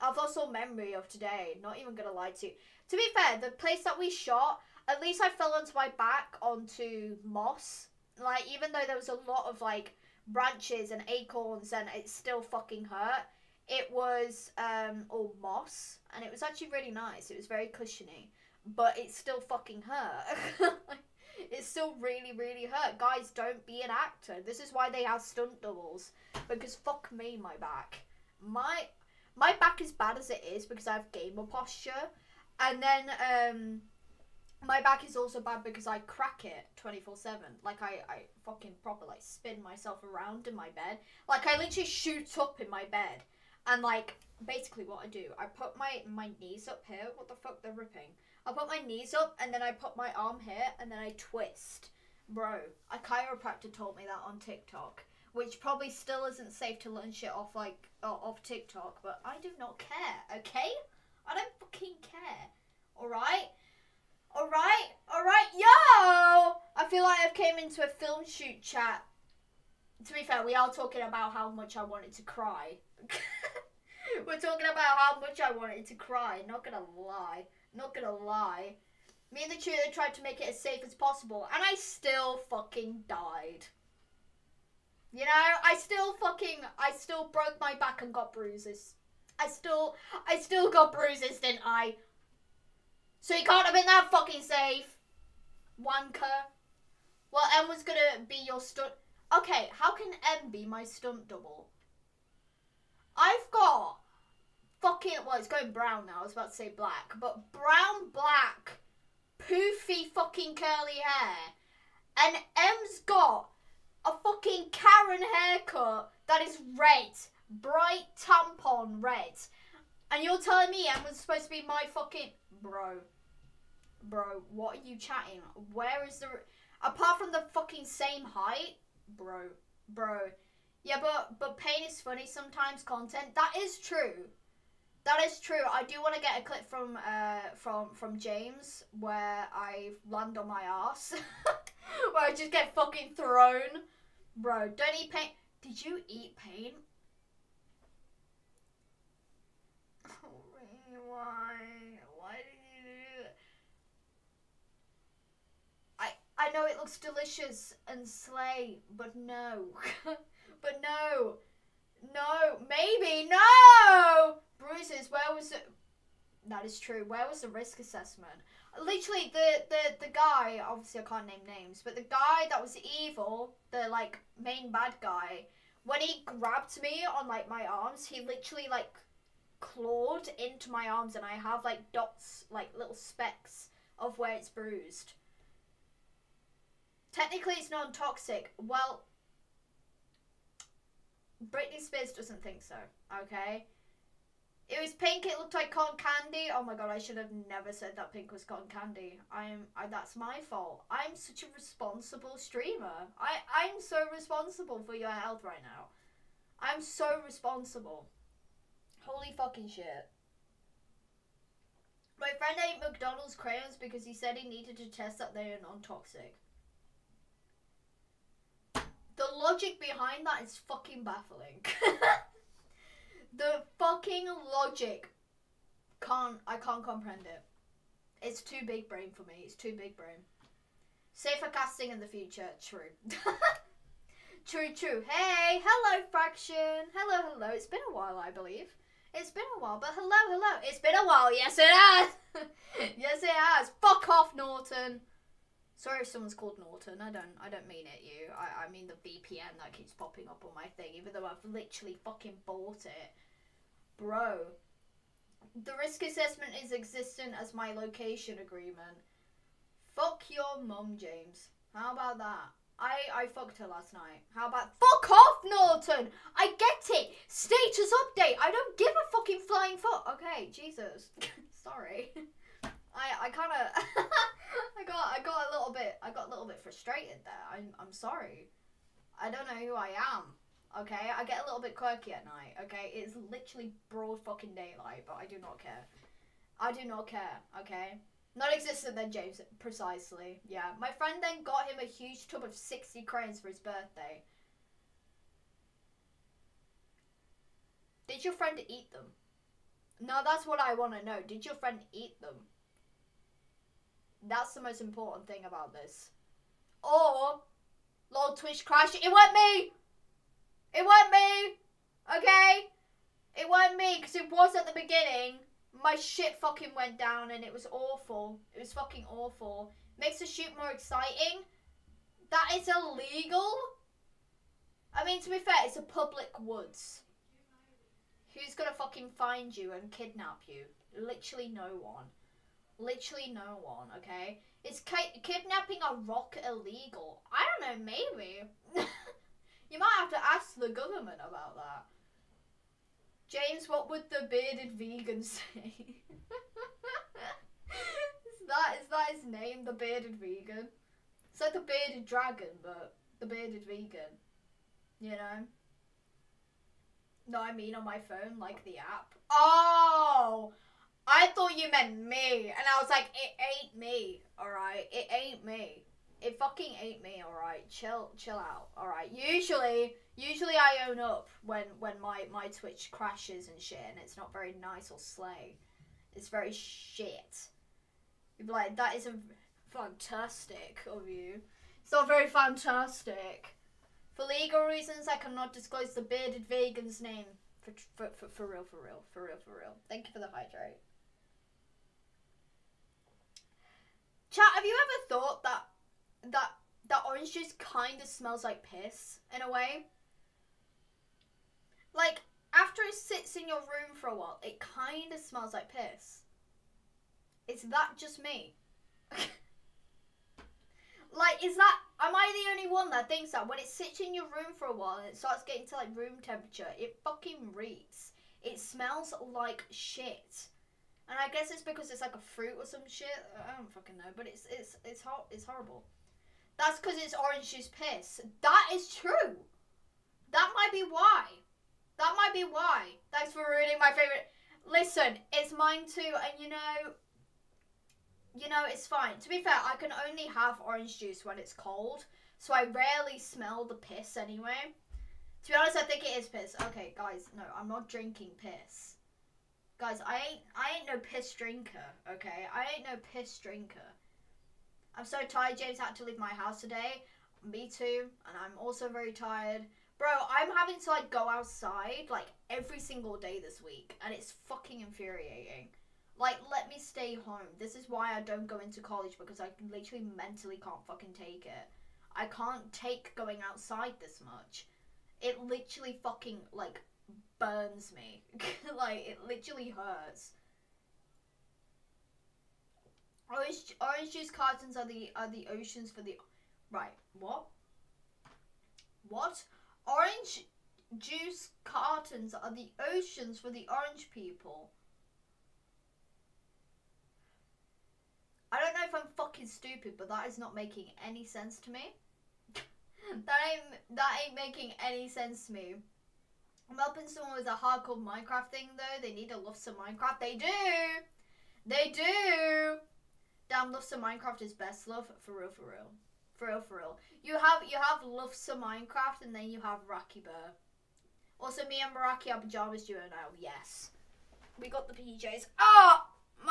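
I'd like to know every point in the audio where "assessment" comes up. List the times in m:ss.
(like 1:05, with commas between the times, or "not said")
2:47, 4:16.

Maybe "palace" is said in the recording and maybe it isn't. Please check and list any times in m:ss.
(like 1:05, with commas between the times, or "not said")
not said.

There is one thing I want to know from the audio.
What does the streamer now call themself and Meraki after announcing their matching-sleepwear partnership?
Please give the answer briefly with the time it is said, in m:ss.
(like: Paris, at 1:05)
pajamas duo, at 8:42.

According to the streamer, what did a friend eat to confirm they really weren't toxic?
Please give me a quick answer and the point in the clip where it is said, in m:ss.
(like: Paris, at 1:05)
McDonald's crayons, at 3:32.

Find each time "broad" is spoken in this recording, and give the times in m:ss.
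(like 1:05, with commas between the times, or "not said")
4:43.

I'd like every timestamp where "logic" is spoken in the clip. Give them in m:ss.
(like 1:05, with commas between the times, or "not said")
3:39, 3:44.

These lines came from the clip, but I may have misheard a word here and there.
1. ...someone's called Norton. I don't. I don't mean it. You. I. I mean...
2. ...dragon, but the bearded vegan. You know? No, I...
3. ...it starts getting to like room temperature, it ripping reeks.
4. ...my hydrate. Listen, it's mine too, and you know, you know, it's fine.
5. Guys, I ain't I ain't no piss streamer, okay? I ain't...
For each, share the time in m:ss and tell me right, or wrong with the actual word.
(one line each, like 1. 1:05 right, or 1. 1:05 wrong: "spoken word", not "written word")
1. 4:06 right
2. 5:52 right
3. 6:55 wrong: "fucking", not "ripping"
4. 7:13 wrong: "favorite", not "hydrate"
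5. 7:29 wrong: "drinker", not "streamer".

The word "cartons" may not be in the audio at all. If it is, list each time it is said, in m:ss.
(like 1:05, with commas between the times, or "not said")
8:04, 8:11.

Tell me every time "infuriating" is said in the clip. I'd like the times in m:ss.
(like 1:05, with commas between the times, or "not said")
7:44.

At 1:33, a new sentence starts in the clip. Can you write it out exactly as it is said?
So he can't have been that fucking safe.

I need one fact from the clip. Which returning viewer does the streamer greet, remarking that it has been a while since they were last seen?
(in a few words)
Fraction.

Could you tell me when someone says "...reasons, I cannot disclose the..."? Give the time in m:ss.
6:24.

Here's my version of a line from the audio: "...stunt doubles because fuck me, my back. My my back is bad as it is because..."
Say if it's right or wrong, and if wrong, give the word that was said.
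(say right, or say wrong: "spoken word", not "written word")
right.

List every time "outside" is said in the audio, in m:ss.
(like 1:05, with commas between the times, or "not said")
7:41, 7:53.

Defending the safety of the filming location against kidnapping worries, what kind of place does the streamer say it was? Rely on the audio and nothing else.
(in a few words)
a public woods.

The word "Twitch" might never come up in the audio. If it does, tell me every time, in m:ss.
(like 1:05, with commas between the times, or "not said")
5:08, 6:12.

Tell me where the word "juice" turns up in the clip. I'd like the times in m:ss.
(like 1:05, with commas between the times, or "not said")
6:37, 7:07, 7:20, 8:04, 8:10.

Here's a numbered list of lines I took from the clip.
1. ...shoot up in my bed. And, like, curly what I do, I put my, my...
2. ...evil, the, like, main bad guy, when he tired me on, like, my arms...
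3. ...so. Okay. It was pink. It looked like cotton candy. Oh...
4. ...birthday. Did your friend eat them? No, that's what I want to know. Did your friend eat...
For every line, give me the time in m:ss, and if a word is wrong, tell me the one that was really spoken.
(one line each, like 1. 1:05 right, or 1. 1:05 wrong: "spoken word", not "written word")
1. 0:41 wrong: "basically", not "curly"
2. 2:53 wrong: "grabbed", not "tired"
3. 3:12 right
4. 4:53 right.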